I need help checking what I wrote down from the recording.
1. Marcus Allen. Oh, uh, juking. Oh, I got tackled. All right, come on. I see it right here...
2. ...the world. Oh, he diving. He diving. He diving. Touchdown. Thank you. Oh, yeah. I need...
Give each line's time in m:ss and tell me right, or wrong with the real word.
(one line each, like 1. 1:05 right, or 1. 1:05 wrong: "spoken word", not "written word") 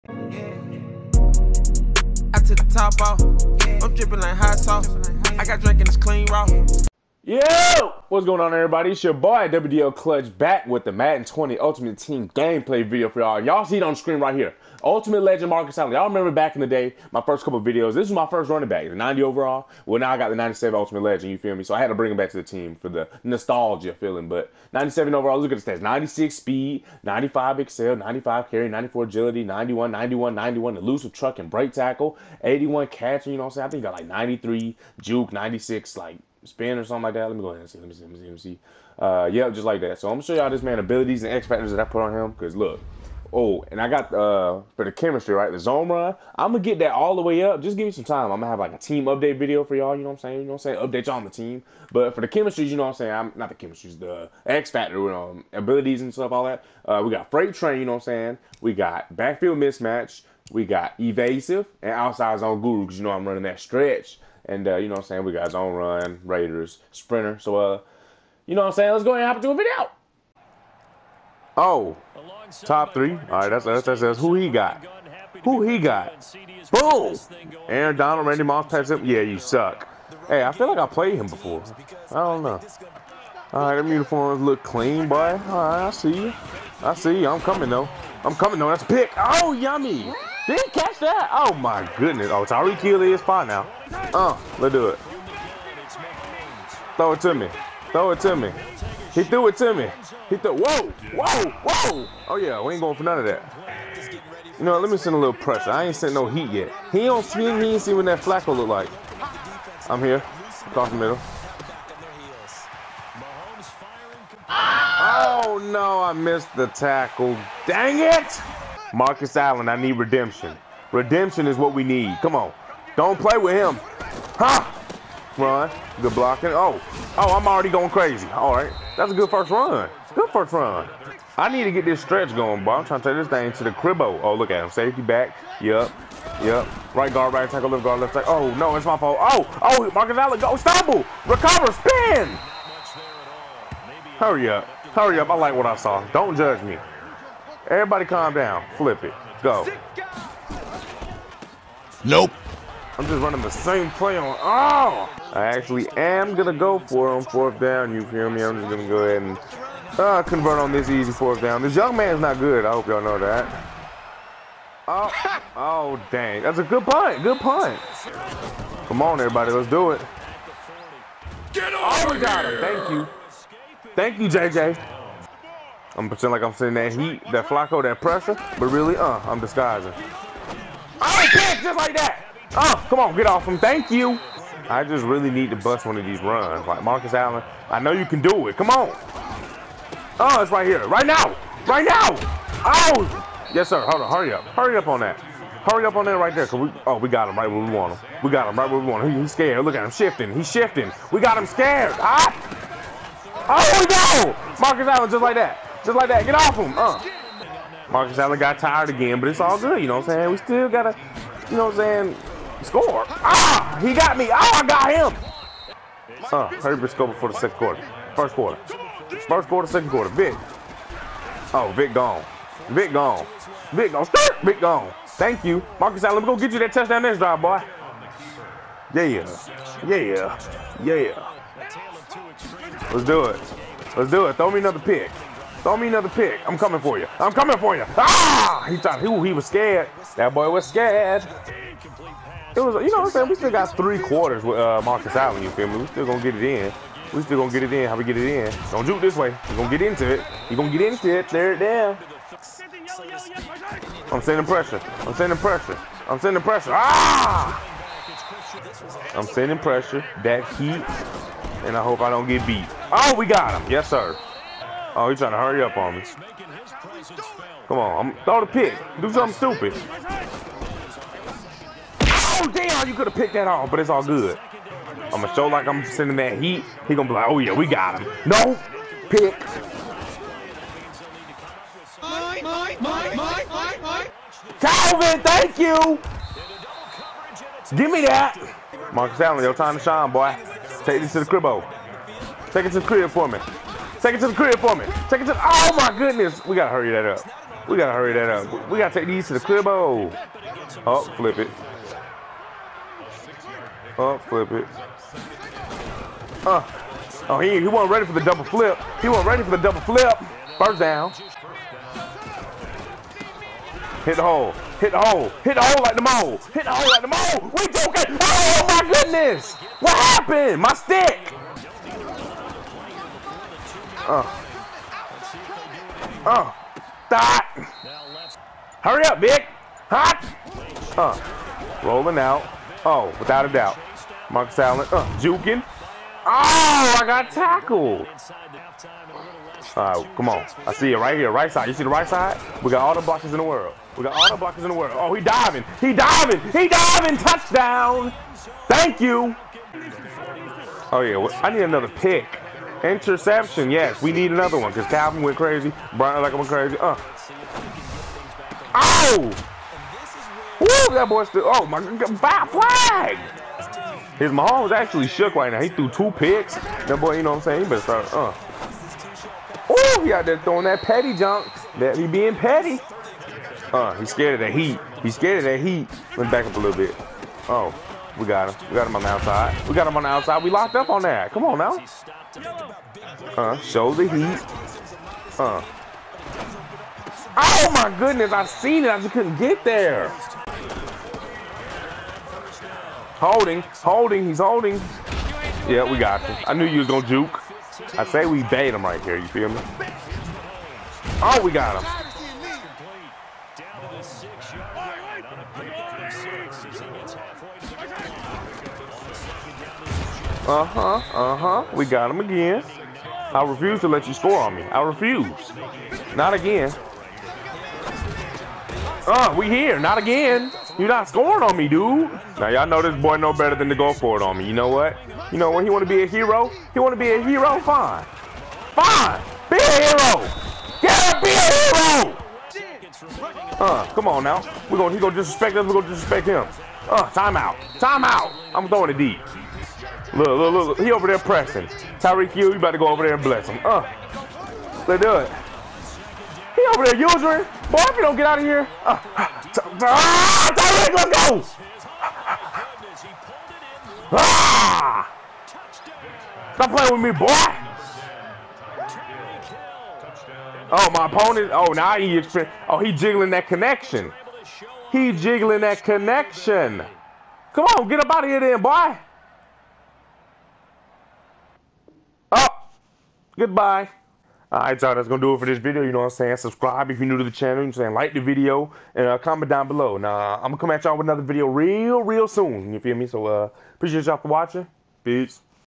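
1. 5:34 right
2. 5:44 right.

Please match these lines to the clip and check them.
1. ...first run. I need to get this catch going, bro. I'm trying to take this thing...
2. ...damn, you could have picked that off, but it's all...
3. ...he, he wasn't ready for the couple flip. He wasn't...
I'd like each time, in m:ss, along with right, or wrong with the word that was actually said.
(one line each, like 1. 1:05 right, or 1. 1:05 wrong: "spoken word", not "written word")
1. 2:10 wrong: "stretch", not "catch"
2. 4:32 right
3. 5:07 wrong: "double", not "couple".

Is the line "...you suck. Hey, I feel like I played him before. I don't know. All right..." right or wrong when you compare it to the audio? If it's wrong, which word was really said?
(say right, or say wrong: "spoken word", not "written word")
right.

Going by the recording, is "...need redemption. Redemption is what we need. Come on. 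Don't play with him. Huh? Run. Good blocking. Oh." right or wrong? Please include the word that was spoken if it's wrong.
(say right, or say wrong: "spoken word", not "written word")
right.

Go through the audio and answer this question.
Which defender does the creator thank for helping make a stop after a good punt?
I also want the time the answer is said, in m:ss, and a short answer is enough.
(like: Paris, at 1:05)
JJ, at 2:54.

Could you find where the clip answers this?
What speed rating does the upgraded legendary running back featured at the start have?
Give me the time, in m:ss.
0:25.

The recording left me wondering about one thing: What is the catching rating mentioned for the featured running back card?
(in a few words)
81.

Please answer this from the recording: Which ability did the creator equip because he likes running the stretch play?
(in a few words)
Outside Zone Guru.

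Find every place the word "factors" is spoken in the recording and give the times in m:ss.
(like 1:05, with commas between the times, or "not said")
0:41, 0:54.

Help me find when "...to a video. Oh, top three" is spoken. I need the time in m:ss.
1:09.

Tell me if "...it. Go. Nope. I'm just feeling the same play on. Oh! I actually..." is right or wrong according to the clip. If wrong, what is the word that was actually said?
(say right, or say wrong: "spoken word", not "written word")
wrong: "running", not "feeling".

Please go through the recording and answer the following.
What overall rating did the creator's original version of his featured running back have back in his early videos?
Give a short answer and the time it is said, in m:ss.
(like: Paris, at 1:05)
90, at 0:18.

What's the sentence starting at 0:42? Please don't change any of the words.
Cause look, oh, and I got uh for the chemistry right, the zone run.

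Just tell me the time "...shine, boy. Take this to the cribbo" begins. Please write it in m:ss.
4:49.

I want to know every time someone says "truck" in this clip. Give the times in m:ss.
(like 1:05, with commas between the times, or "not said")
0:31.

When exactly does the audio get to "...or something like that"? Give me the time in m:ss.
0:36.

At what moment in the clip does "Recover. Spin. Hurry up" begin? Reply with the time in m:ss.
2:21.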